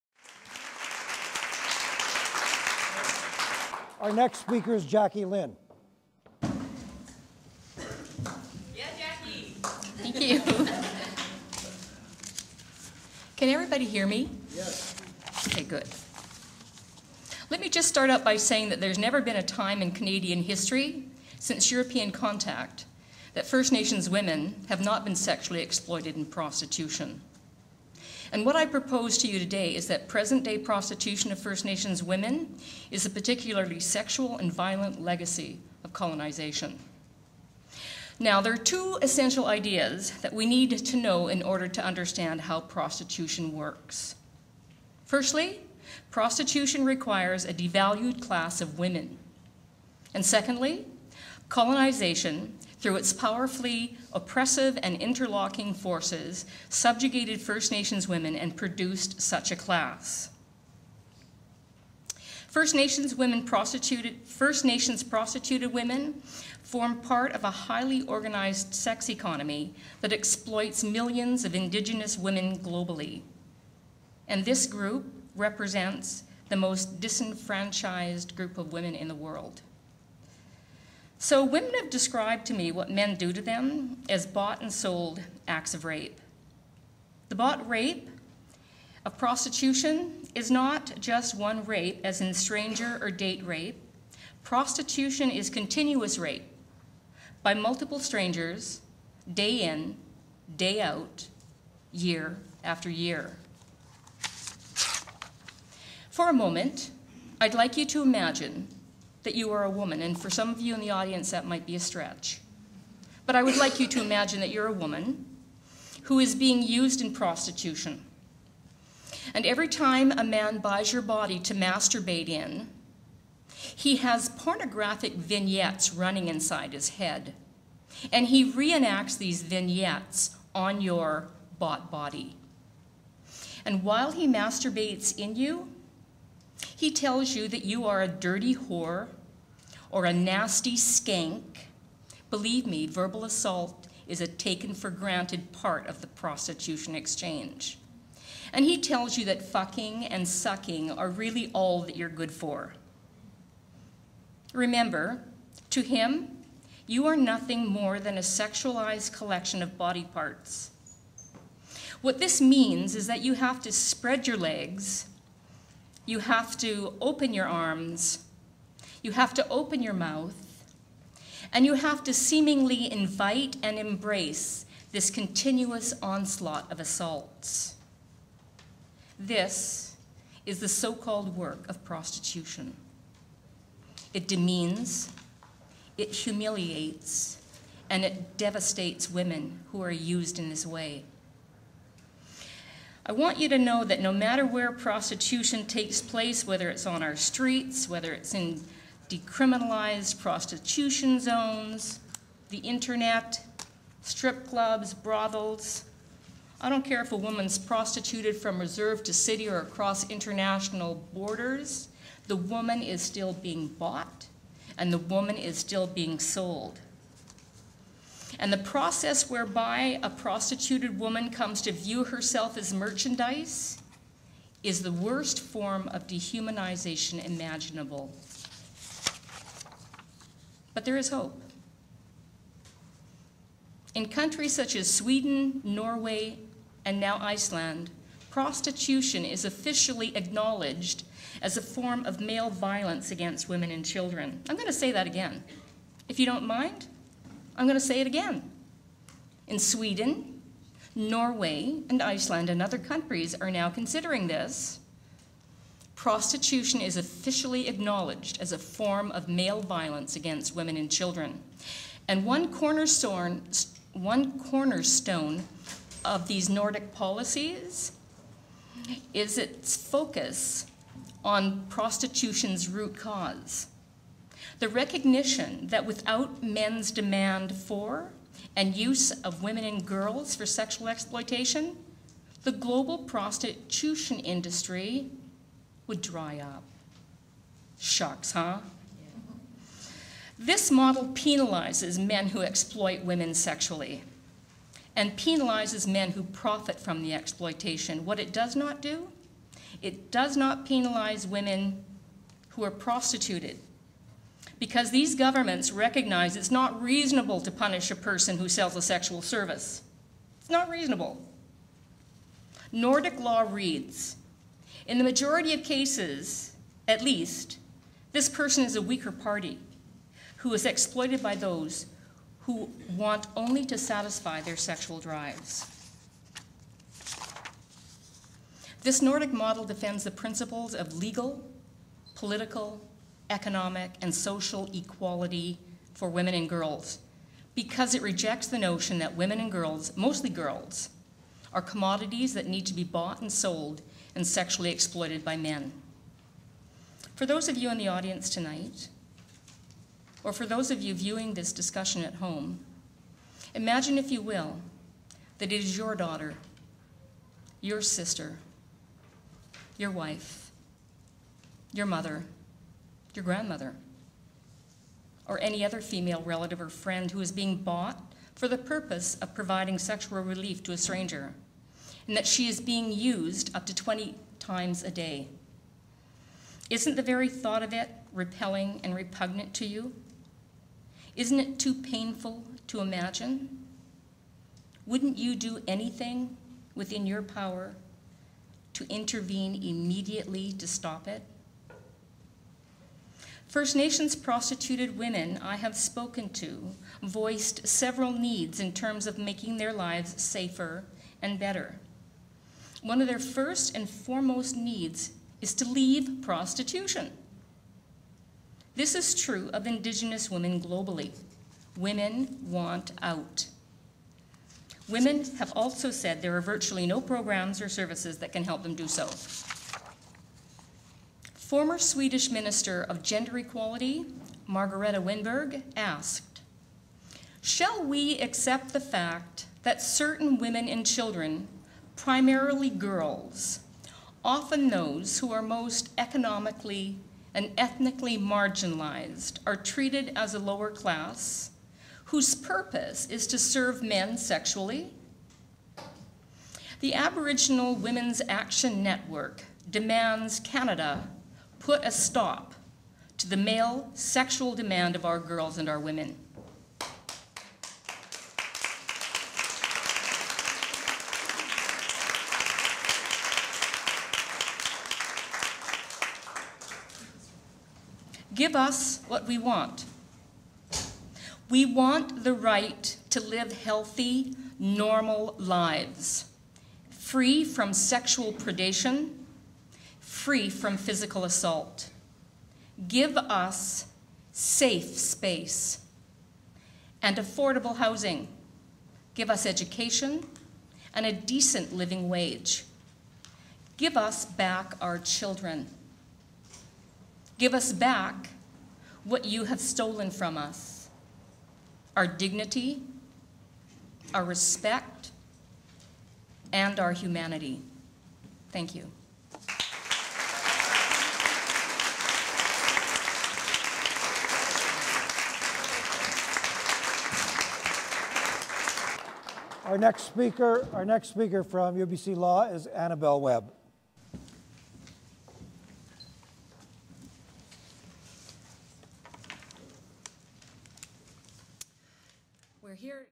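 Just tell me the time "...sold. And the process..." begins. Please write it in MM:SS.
03:36.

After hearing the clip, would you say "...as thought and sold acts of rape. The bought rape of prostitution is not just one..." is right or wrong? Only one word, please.
wrong.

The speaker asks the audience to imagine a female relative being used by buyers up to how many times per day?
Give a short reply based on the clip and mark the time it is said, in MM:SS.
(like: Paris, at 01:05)
20, at 06:13.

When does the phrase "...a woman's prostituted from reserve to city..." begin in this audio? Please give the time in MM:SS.
03:27.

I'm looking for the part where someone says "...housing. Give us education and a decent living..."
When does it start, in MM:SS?
08:07.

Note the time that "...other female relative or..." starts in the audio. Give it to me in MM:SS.
06:05.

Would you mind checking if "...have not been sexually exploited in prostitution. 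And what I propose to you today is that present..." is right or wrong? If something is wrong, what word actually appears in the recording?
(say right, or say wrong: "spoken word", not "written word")
right.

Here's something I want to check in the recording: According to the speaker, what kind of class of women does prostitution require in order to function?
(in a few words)
A devalued class.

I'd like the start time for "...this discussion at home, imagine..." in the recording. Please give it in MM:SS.
05:51.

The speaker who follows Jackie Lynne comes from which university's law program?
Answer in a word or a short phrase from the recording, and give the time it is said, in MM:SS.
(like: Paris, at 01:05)
UBC, at 08:41.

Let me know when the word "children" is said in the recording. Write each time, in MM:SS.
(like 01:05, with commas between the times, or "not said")
04:03, 04:20, 07:10, 08:14.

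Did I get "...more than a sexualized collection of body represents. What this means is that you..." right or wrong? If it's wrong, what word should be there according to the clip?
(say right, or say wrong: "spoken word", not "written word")
wrong: "parts", not "represents".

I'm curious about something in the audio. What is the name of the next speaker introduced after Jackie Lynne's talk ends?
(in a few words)
Annabel Webb.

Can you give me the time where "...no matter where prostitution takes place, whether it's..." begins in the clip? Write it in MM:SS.
03:14.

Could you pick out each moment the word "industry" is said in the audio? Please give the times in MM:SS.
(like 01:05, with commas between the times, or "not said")
04:44.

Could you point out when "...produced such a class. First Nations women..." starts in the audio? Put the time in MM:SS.
00:58.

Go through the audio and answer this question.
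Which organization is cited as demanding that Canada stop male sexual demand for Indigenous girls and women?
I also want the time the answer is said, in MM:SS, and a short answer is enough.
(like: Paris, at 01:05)
Aboriginal Women's Action Network, at 07:26.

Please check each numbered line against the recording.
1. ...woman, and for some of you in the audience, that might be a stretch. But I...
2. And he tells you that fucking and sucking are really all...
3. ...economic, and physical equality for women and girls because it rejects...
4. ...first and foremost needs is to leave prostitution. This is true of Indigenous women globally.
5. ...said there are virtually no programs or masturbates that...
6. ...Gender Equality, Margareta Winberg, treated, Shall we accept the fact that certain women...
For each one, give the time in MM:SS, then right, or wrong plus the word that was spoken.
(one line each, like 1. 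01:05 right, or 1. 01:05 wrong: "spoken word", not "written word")
1. 01:49 right
2. 02:28 right
3. 05:33 wrong: "social", not "physical"
4. 06:43 right
5. 06:55 wrong: "services", not "masturbates"
6. 07:03 wrong: "asked", not "treated".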